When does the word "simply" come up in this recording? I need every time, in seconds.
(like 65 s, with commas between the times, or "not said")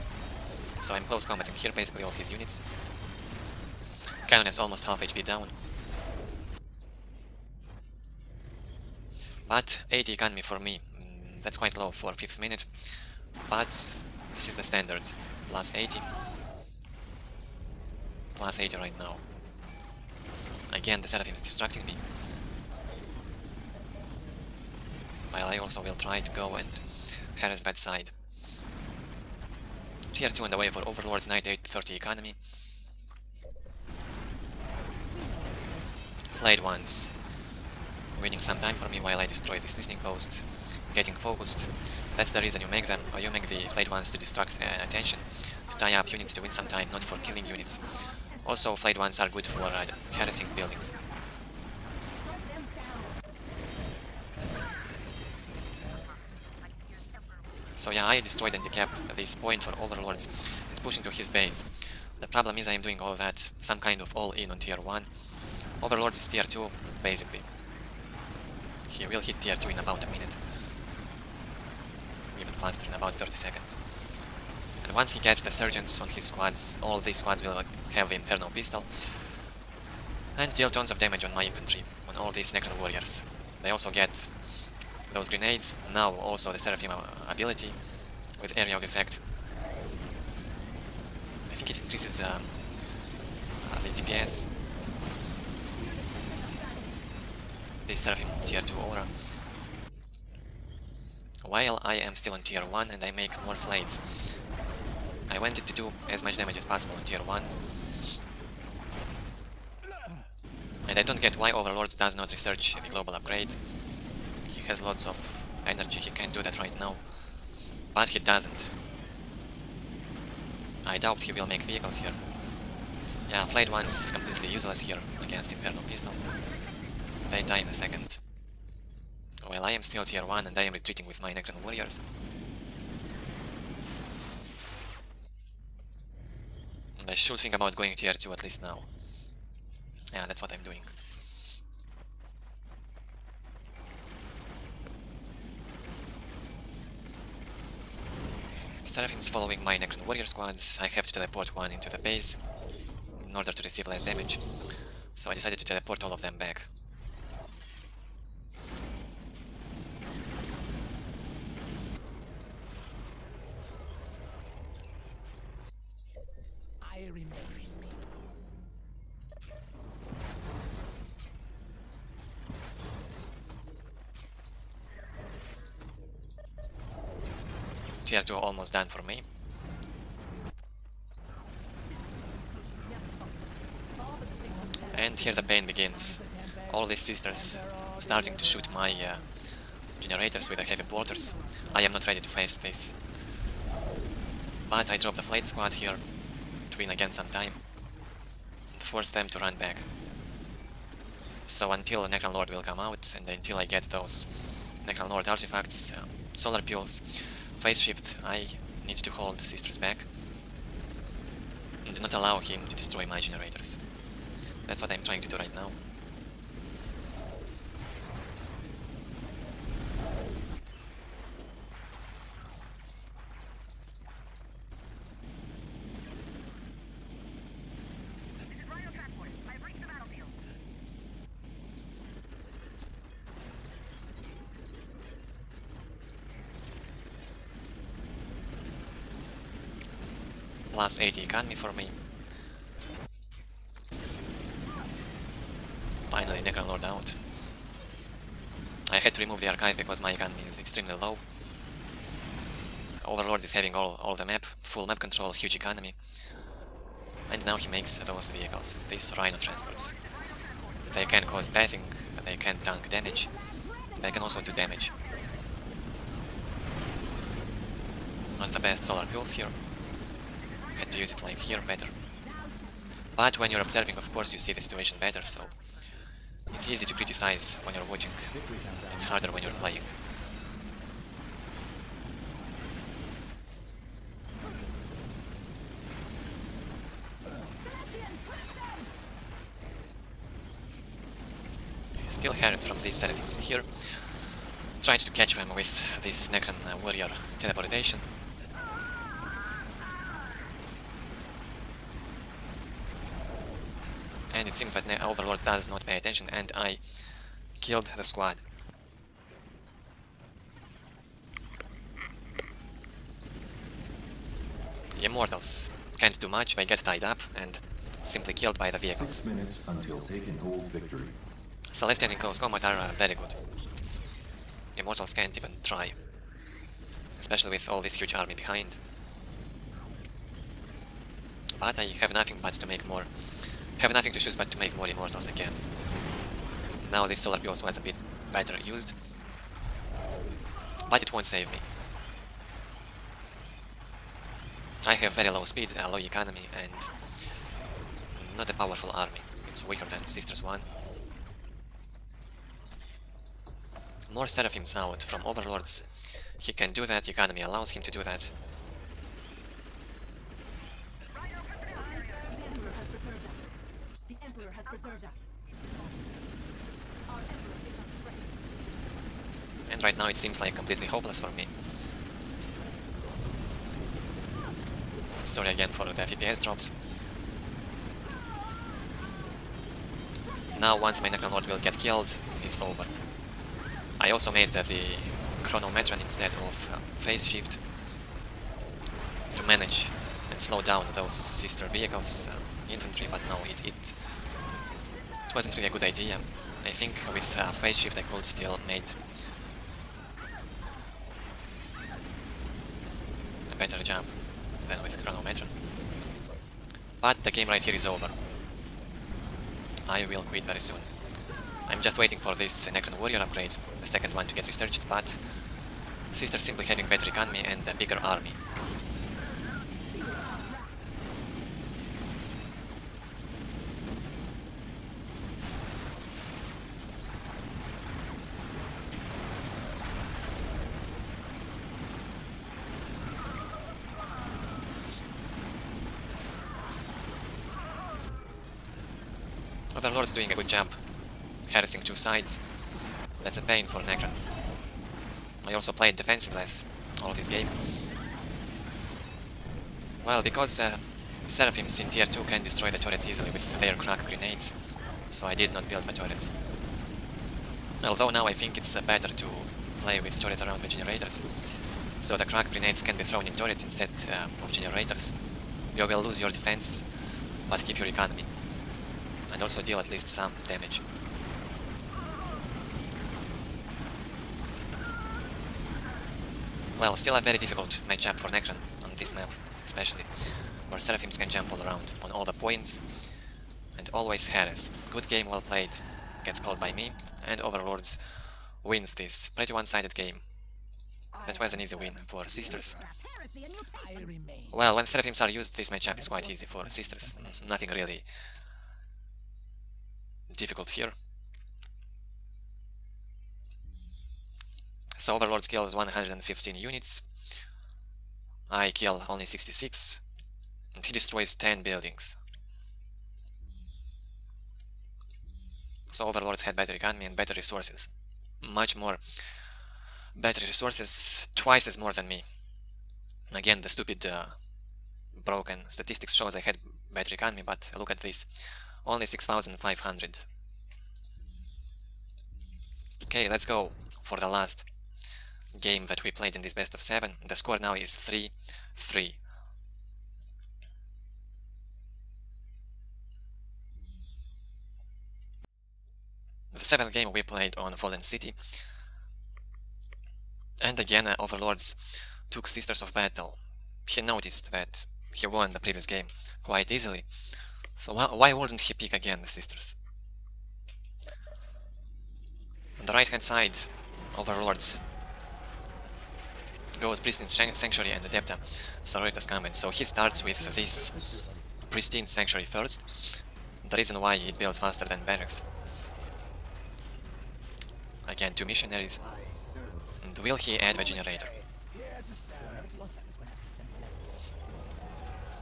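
318 s, 416 s.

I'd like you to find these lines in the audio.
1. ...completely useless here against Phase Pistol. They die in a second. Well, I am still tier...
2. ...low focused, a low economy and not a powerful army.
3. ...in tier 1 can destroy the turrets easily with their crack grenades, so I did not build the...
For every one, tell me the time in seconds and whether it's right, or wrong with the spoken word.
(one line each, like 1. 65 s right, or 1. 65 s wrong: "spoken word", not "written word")
1. 124 s wrong: "Inferno", not "Phase"
2. 345 s wrong: "speed", not "focused"
3. 451 s wrong: "2", not "1".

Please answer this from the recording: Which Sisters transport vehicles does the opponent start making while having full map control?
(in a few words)
Rhino transports.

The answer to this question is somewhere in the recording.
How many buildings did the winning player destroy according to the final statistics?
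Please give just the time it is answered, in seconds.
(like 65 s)
511 s.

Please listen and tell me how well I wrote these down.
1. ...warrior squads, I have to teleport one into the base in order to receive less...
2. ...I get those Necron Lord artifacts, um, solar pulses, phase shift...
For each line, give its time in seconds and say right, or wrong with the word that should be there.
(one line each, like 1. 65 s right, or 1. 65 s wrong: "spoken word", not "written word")
1. 150 s right
2. 203 s right.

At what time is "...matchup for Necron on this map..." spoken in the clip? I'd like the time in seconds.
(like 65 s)
477 s.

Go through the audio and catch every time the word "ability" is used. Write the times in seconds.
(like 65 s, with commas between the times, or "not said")
87 s.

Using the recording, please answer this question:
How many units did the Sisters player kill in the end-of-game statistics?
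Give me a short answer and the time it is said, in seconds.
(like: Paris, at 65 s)
115, at 505 s.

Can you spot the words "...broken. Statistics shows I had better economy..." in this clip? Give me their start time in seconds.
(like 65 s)
525 s.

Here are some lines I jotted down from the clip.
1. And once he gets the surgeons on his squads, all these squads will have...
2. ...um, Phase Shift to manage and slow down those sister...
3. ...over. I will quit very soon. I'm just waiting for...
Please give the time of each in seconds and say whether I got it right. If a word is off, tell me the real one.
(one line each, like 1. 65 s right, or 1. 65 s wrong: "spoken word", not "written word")
1. 74 s right
2. 386 s right
3. 407 s right.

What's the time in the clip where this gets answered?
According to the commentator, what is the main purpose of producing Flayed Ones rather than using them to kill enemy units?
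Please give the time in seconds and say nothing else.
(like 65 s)
45 s.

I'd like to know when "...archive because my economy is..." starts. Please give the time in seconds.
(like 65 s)
249 s.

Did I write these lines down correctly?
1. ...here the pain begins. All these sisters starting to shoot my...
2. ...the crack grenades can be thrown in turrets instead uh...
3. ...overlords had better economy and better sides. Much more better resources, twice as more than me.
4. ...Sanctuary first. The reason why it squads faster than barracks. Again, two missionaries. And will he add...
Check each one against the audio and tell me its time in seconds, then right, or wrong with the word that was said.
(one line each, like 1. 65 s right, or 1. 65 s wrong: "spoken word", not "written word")
1. 185 s right
2. 462 s right
3. 516 s wrong: "resources", not "sides"
4. 572 s wrong: "builds", not "squads".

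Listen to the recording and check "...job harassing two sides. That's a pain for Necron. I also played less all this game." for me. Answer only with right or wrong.
right.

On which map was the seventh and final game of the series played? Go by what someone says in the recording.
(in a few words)
Fallen City.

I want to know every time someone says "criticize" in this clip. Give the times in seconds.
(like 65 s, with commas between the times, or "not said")
276 s.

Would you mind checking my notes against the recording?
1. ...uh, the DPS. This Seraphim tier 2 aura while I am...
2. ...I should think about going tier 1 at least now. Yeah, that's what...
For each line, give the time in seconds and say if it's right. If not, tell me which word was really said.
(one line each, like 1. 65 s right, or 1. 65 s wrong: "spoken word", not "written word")
1. 93 s right
2. 137 s wrong: "2", not "1".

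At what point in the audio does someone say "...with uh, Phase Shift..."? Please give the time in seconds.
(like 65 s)
397 s.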